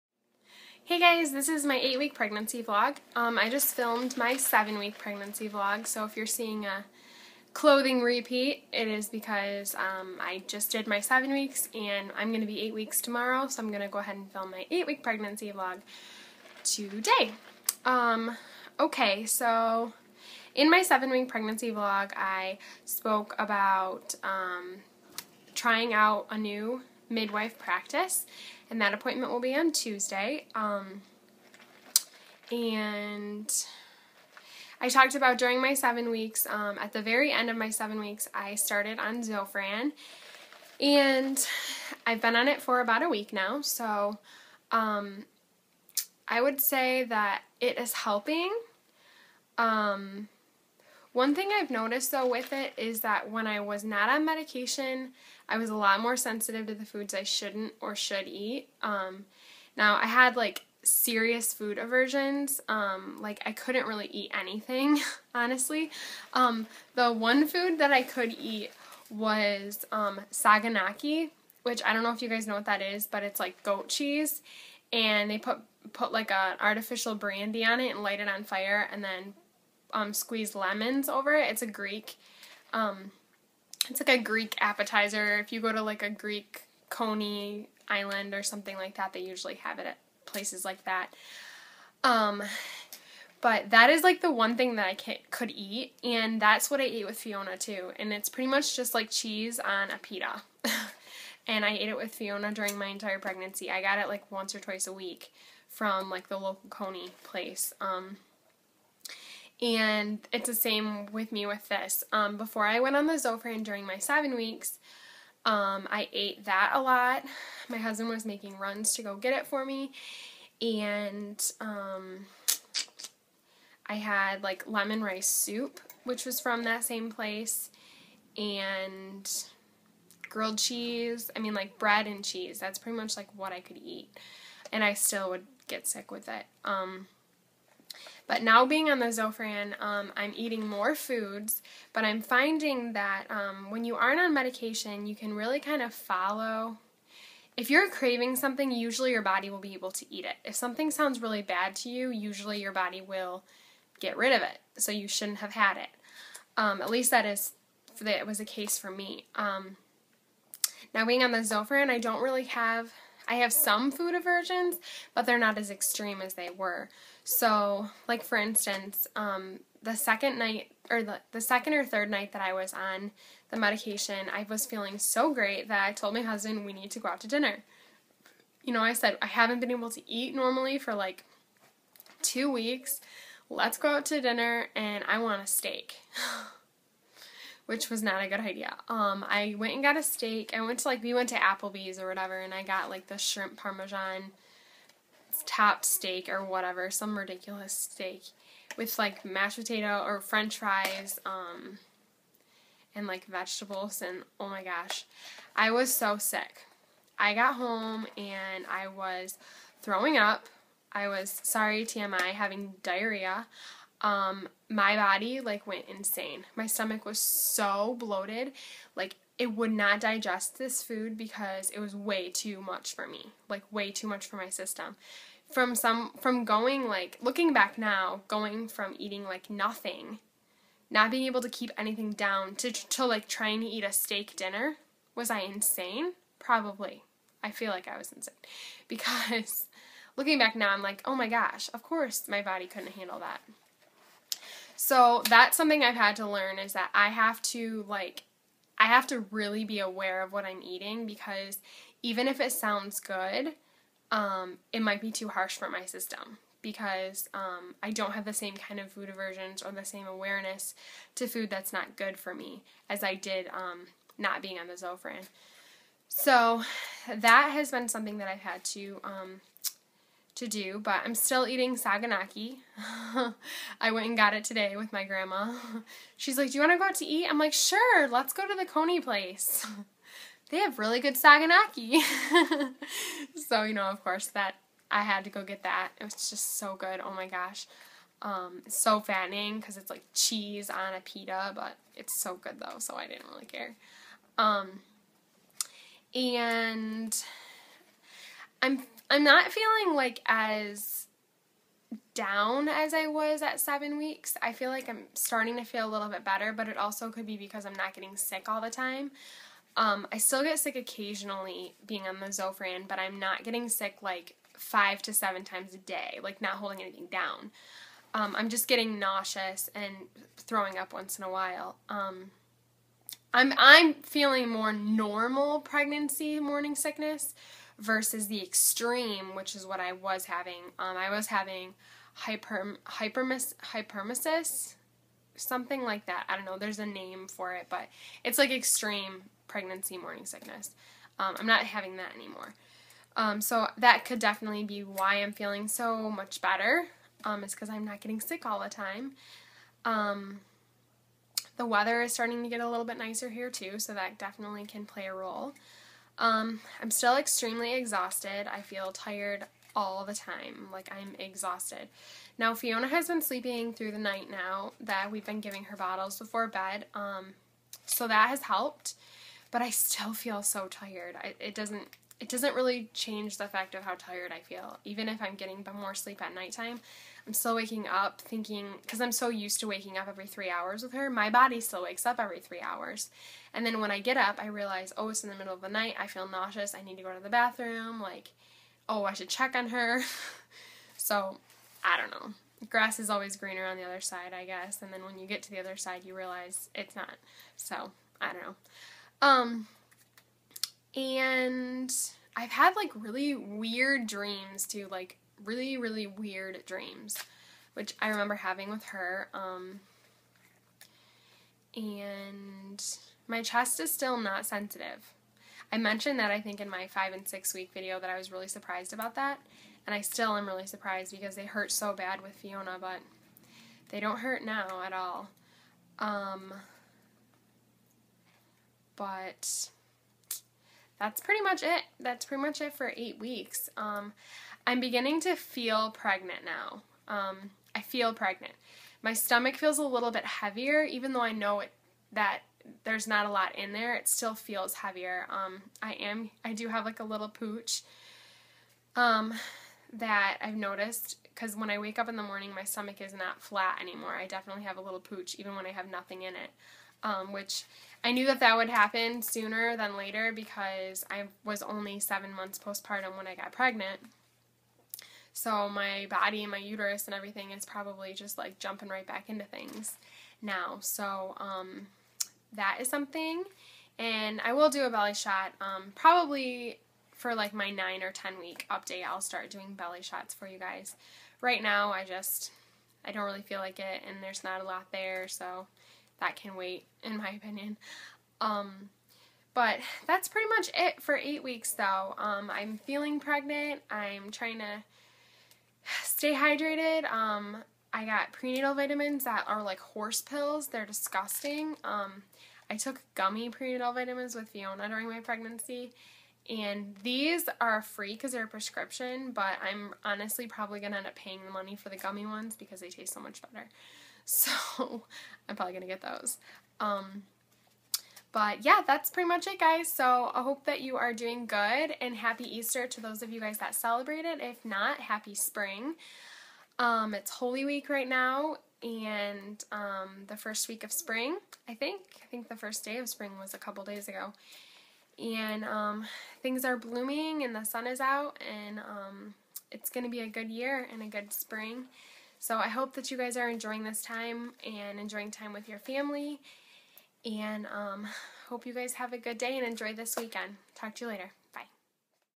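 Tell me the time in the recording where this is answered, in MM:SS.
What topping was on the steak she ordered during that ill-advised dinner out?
03:13.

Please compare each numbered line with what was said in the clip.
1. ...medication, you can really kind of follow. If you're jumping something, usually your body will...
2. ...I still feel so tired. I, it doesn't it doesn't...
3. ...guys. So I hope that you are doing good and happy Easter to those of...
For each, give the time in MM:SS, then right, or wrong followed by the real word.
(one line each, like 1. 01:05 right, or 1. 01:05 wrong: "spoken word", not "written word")
1. 02:24 wrong: "craving", not "jumping"
2. 06:09 right
3. 08:39 right.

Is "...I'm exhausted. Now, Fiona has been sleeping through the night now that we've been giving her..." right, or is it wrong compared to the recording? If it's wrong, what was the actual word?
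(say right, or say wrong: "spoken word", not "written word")
right.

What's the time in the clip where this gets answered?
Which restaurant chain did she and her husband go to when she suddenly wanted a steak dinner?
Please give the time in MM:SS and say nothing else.
03:11.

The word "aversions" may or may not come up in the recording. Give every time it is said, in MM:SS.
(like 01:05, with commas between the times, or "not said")
01:01, 02:44, 04:19.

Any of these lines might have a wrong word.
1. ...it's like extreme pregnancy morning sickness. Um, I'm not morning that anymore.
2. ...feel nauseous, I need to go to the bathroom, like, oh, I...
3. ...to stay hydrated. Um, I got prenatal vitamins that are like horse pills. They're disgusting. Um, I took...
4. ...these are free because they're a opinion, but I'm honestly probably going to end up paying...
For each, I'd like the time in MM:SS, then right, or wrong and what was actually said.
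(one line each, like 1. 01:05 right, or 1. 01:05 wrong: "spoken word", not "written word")
1. 05:38 wrong: "having", not "morning"
2. 06:26 right
3. 08:14 right
4. 08:27 wrong: "prescription", not "opinion".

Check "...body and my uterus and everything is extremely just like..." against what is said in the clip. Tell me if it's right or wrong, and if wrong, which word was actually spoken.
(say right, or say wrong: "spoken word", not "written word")
wrong: "probably", not "extremely".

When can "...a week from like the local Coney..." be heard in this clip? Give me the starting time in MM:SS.
01:44.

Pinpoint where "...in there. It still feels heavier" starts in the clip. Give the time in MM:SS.
07:23.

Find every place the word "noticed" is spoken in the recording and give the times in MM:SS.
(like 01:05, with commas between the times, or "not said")
00:51, 07:30.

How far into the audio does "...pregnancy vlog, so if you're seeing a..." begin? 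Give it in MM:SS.
00:04.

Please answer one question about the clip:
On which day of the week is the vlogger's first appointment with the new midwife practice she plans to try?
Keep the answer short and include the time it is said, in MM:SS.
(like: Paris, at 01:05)
Tuesday, at 00:29.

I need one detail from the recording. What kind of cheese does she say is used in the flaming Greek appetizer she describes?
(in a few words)
goat cheese.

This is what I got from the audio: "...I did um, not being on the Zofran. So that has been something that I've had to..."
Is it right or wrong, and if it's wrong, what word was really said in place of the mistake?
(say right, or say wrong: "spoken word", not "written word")
right.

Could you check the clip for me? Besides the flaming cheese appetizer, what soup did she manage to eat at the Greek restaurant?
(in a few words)
lemon rice soup.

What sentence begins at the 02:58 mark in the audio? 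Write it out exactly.
You know, I said I haven't been able to eat normally for like two weeks.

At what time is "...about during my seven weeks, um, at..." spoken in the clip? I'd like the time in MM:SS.
00:35.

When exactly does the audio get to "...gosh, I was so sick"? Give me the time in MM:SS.
03:24.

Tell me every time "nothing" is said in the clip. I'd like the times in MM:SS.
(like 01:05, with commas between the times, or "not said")
03:49, 07:35.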